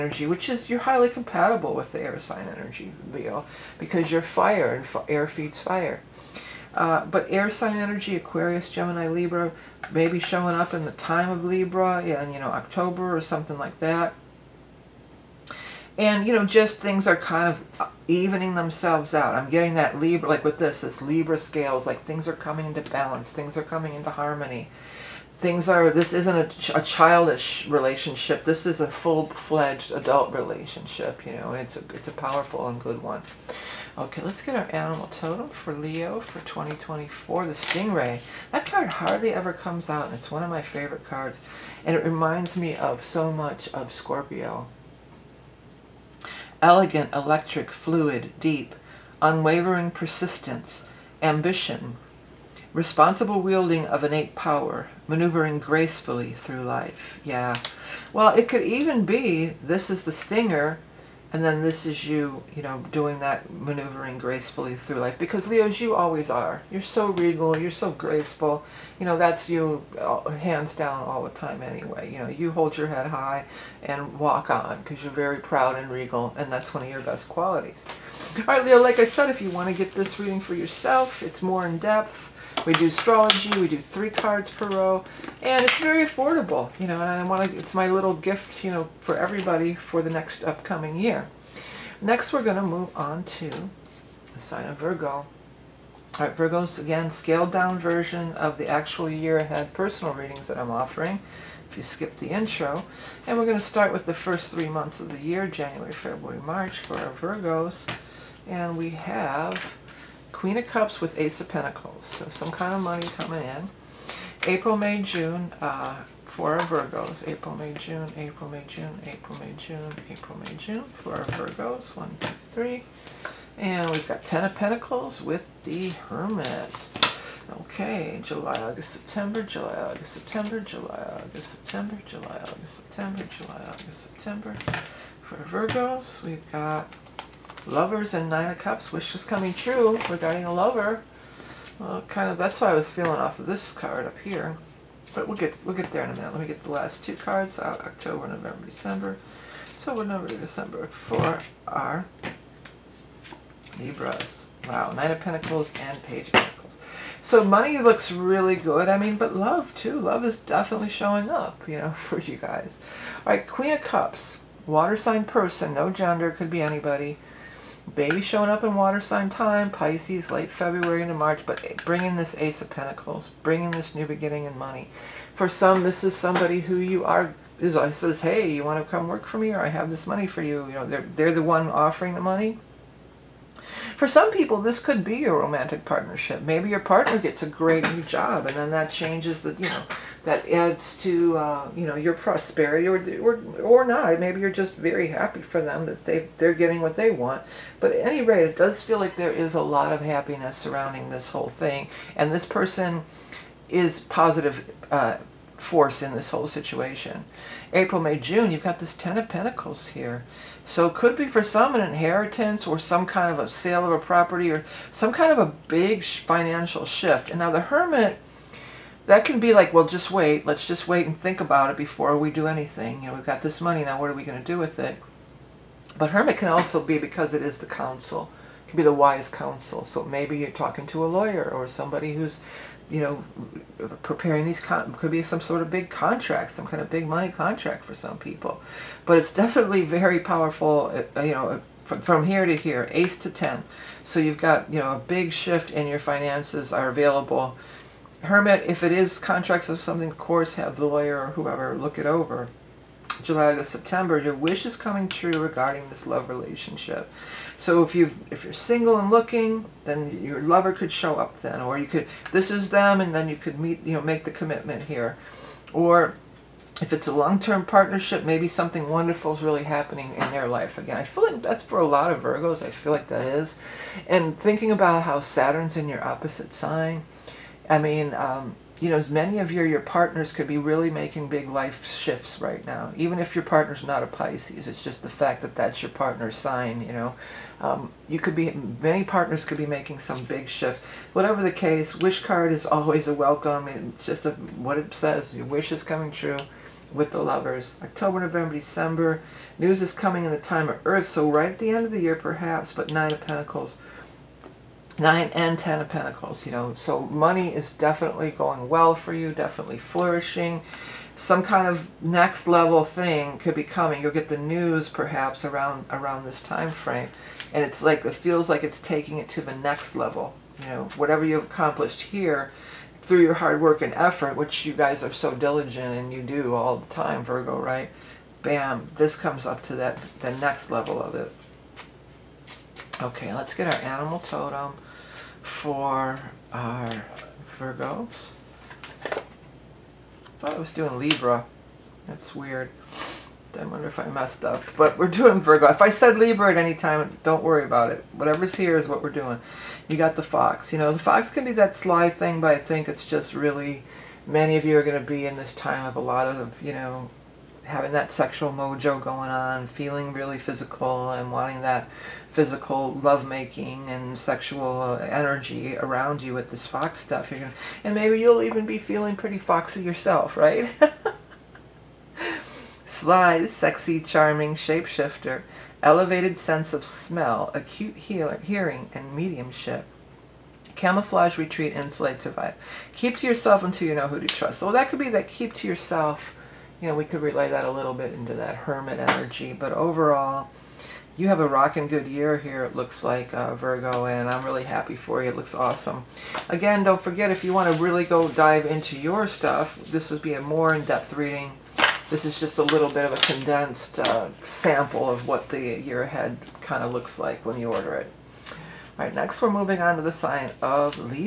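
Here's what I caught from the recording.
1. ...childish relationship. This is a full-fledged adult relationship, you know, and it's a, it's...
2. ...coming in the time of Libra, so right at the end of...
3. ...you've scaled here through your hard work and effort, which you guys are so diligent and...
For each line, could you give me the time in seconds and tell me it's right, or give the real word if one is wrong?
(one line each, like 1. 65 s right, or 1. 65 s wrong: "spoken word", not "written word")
1. 26 s right
2. 299 s wrong: "Earth", not "Libra"
3. 321 s wrong: "accomplished", not "scaled".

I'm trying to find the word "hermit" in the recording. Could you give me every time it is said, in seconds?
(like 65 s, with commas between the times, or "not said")
125 s, 217 s, 226 s, 248 s, 388 s.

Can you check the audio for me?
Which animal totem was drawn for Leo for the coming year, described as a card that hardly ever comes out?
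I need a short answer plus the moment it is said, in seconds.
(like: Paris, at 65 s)
Stingray, at 37 s.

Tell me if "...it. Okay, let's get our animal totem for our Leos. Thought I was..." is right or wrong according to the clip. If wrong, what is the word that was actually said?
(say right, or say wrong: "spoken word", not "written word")
wrong: "Virgos", not "Leos".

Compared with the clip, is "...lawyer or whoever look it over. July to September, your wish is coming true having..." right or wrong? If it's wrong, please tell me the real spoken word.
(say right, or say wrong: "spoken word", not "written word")
wrong: "regarding", not "having".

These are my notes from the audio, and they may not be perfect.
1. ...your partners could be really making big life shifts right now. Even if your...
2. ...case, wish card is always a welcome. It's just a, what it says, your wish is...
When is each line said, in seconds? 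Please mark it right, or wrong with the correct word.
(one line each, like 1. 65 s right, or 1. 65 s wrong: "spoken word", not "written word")
1. 279 s right
2. 291 s right.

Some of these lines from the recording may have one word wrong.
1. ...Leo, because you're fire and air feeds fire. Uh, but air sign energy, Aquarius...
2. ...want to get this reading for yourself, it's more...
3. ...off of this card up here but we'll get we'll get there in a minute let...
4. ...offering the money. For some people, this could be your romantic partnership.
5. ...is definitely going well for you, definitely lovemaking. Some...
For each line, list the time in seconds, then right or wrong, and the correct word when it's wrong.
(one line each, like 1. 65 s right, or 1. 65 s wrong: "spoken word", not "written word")
1. 3 s right
2. 79 s right
3. 143 s right
4. 181 s right
5. 307 s wrong: "flourishing", not "lovemaking".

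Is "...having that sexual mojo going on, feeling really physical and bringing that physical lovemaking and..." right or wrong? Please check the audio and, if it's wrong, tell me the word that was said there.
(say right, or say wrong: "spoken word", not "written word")
wrong: "wanting", not "bringing".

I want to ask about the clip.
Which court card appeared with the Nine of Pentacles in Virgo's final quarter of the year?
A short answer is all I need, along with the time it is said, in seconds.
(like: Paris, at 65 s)
Page of Pentacles, at 156 s.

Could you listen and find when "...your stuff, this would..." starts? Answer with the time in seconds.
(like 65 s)
398 s.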